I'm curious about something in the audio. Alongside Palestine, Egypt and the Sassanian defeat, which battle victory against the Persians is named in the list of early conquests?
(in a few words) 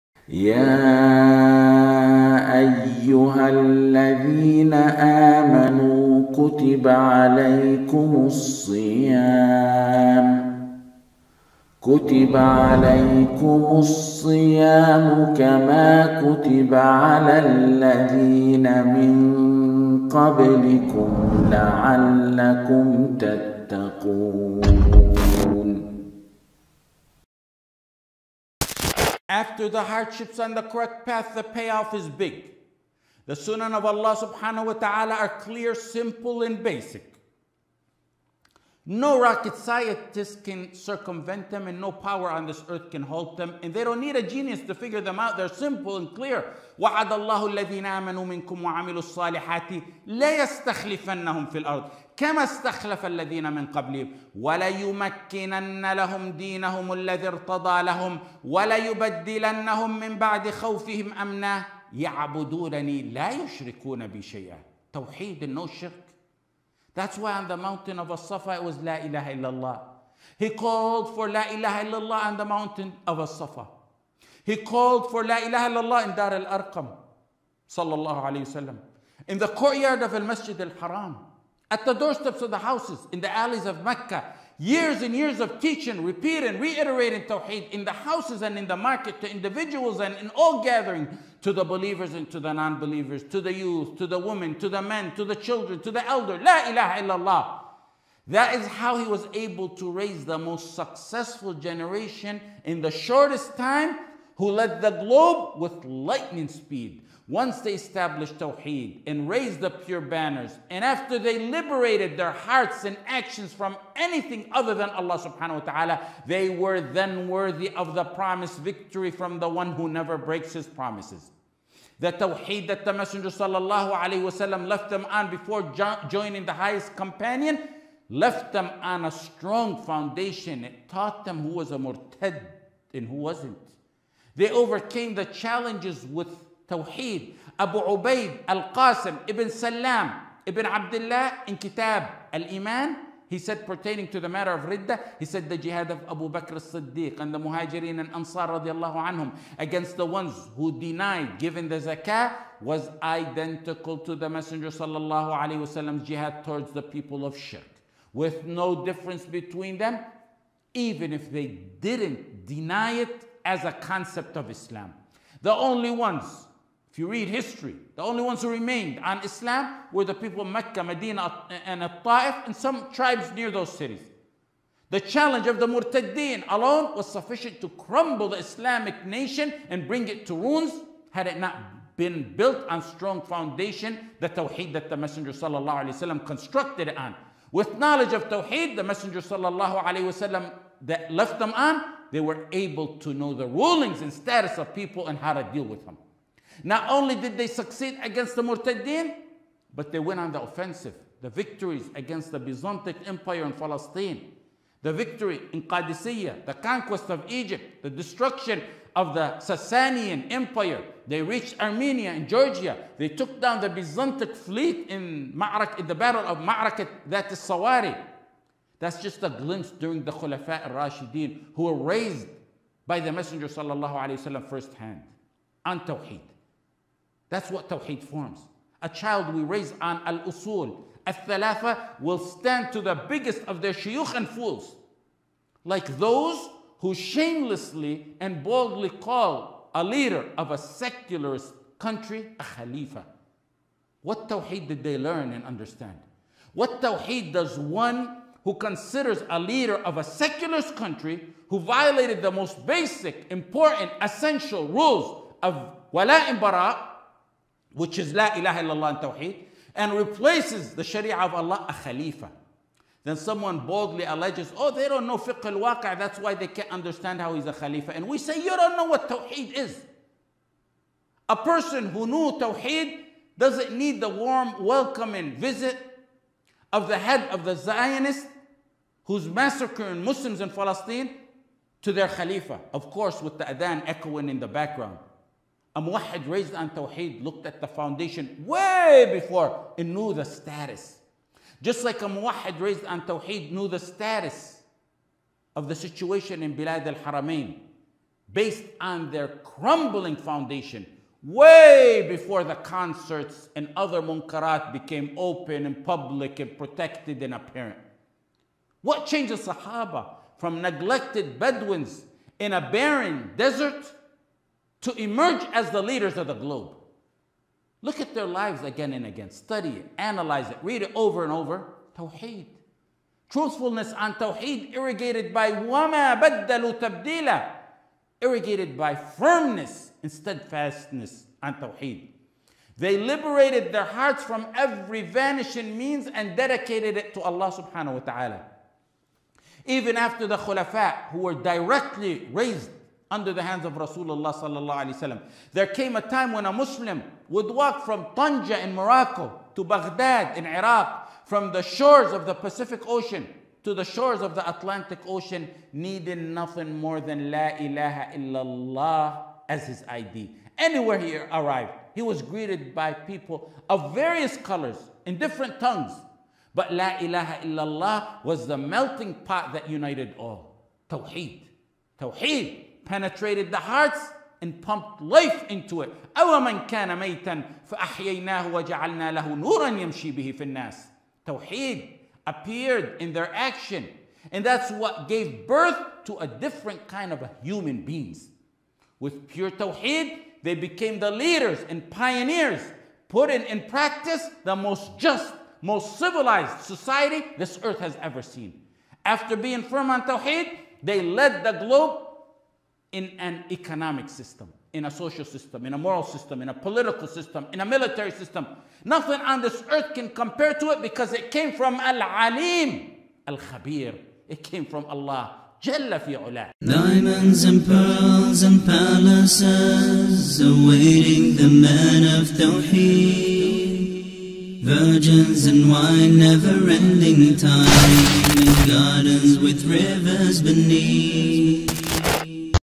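Qadisiyah.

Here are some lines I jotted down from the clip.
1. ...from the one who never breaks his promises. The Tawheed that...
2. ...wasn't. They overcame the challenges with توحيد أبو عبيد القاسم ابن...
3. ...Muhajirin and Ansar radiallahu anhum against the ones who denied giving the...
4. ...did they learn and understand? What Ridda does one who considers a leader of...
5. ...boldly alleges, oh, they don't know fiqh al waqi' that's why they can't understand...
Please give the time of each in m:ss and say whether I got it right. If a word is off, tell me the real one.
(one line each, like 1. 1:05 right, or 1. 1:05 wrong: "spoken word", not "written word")
1. 1:59 right
2. 2:13 right
3. 2:27 right
4. 4:04 wrong: "Tawheed", not "Ridda"
5. 4:23 right.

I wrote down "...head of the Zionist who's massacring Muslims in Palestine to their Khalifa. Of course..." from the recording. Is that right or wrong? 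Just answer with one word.
right.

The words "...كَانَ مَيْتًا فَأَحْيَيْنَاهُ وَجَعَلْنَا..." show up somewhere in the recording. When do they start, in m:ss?
6:16.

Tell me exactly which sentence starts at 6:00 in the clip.
Anywhere he arrived, he was greeted by people of various colors in different tongues.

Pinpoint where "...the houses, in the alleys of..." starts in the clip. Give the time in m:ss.
1:22.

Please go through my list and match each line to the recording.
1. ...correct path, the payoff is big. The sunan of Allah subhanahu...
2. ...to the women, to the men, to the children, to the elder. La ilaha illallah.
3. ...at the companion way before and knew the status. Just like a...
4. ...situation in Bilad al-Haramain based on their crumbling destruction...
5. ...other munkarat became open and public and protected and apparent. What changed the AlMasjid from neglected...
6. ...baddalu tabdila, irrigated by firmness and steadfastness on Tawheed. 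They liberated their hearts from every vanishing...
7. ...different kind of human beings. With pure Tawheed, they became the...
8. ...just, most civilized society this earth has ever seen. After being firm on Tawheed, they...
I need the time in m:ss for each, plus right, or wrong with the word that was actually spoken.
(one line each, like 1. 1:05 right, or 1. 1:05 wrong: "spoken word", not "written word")
1. 0:30 right
2. 1:33 right
3. 4:47 wrong: "foundation", not "companion"
4. 4:55 wrong: "foundation", not "destruction"
5. 5:03 wrong: "Sahaba", not "AlMasjid"
6. 5:26 right
7. 6:26 right
8. 6:34 right.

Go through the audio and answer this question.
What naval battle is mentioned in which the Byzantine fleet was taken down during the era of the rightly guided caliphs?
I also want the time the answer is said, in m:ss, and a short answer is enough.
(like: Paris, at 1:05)
Dhat as-Sawari, at 3:37.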